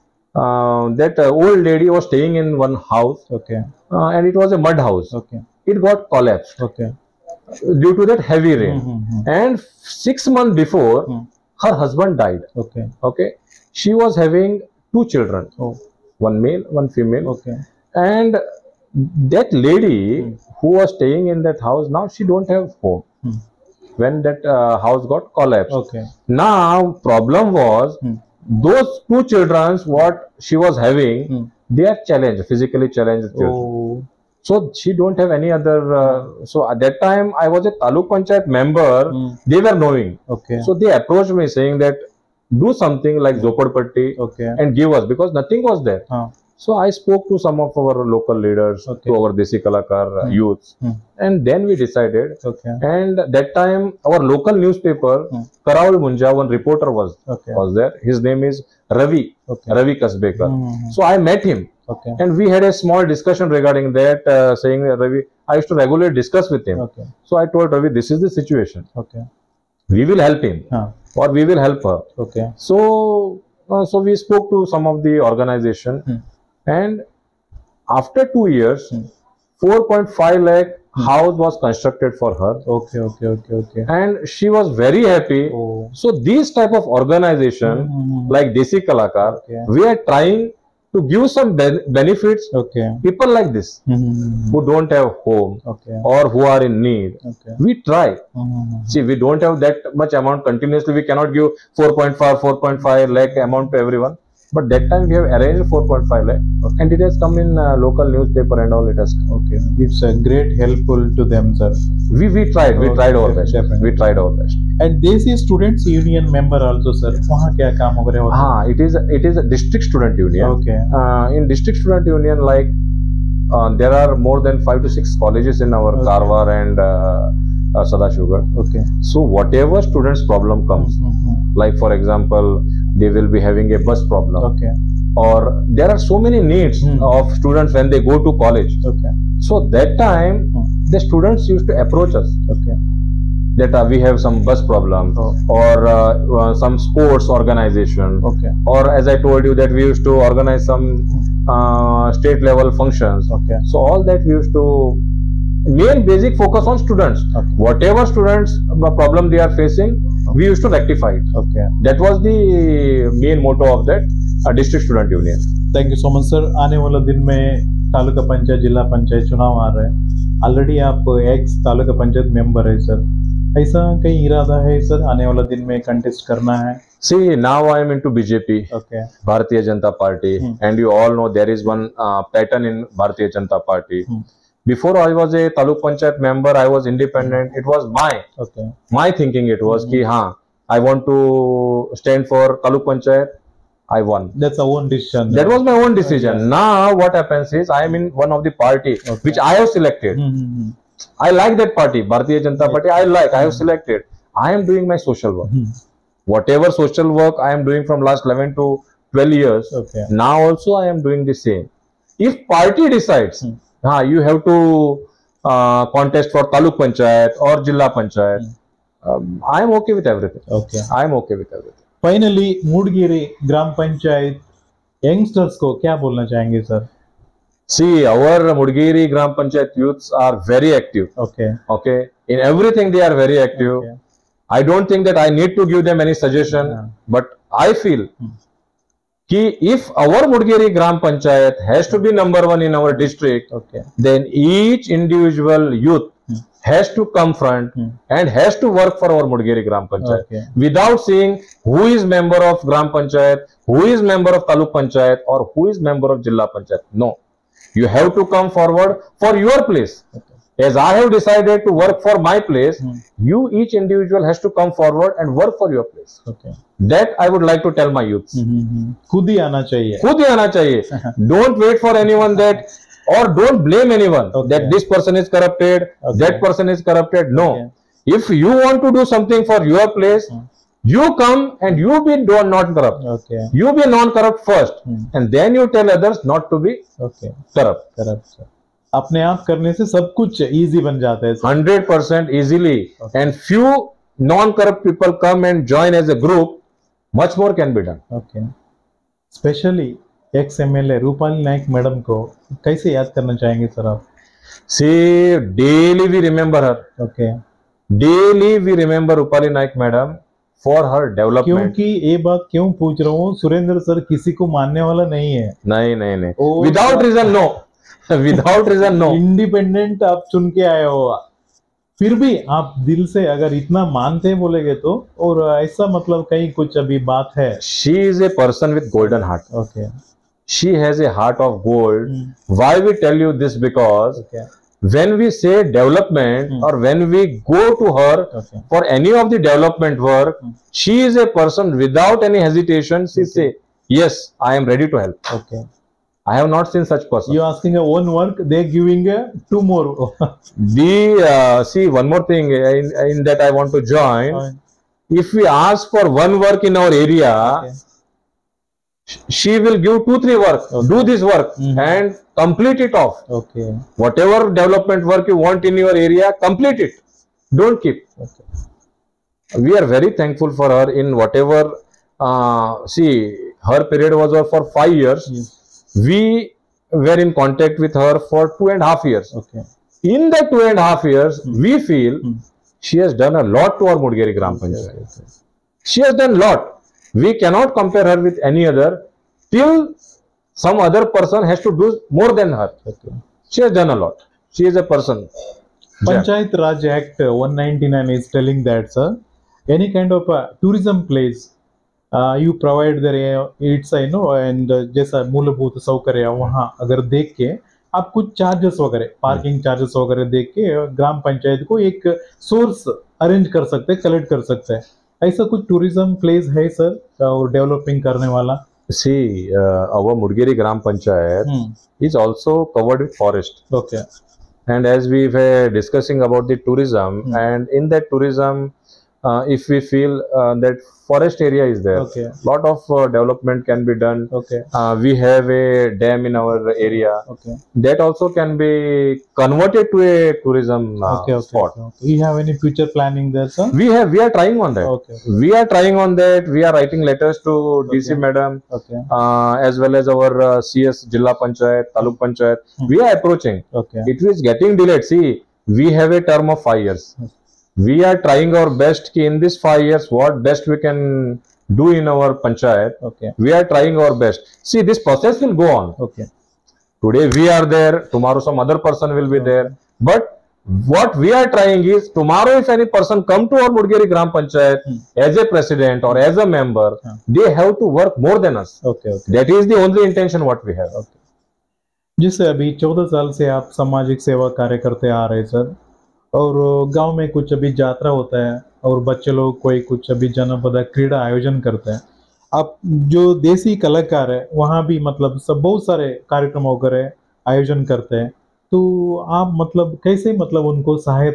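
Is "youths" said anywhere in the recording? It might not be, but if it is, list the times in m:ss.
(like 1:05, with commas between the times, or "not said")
0:50, 4:28.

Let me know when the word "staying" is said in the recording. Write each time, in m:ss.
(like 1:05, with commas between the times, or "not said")
0:02, 0:20.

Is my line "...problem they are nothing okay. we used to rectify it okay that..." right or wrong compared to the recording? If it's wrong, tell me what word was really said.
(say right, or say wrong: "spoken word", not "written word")
wrong: "facing", not "nothing".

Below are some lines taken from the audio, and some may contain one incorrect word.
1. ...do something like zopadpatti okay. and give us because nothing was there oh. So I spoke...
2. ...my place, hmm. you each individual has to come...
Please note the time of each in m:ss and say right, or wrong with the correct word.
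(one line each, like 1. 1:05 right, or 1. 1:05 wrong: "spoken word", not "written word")
1. 0:42 right
2. 4:22 right.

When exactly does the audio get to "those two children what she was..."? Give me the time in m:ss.
0:28.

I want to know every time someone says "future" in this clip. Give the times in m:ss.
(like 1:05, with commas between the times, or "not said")
7:22.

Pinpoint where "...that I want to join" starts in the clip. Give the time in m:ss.
5:53.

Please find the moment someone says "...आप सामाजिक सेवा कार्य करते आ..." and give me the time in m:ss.
8:03.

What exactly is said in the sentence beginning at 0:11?
her husband died okay okay she was having two children oh.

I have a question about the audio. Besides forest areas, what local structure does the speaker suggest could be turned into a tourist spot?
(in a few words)
A dam.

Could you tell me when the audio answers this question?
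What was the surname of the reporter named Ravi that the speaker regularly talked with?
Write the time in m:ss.
0:59.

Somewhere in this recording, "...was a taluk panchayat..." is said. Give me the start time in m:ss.
0:37.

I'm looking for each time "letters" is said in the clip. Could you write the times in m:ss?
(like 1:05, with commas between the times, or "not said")
7:27.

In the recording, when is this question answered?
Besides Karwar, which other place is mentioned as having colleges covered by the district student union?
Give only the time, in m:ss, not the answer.
2:07.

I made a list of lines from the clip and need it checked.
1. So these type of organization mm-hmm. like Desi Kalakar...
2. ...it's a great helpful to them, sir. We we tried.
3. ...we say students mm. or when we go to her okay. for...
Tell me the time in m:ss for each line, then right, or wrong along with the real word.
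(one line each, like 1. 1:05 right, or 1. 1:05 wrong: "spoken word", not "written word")
1. 1:25 right
2. 1:49 right
3. 5:35 wrong: "development", not "students".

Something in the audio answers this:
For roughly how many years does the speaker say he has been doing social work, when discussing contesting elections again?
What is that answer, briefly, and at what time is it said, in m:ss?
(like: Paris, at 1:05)
11 to 12 years, at 3:28.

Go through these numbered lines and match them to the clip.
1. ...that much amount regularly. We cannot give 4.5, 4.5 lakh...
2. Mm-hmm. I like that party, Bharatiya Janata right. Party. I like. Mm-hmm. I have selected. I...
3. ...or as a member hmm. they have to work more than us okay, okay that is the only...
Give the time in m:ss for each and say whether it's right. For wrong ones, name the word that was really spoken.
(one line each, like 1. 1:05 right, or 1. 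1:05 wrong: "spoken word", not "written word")
1. 1:39 wrong: "continuously", not "regularly"
2. 3:20 right
3. 7:56 right.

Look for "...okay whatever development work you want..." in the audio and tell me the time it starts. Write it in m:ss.
6:03.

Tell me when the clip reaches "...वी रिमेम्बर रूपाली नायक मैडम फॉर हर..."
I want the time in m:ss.
5:08.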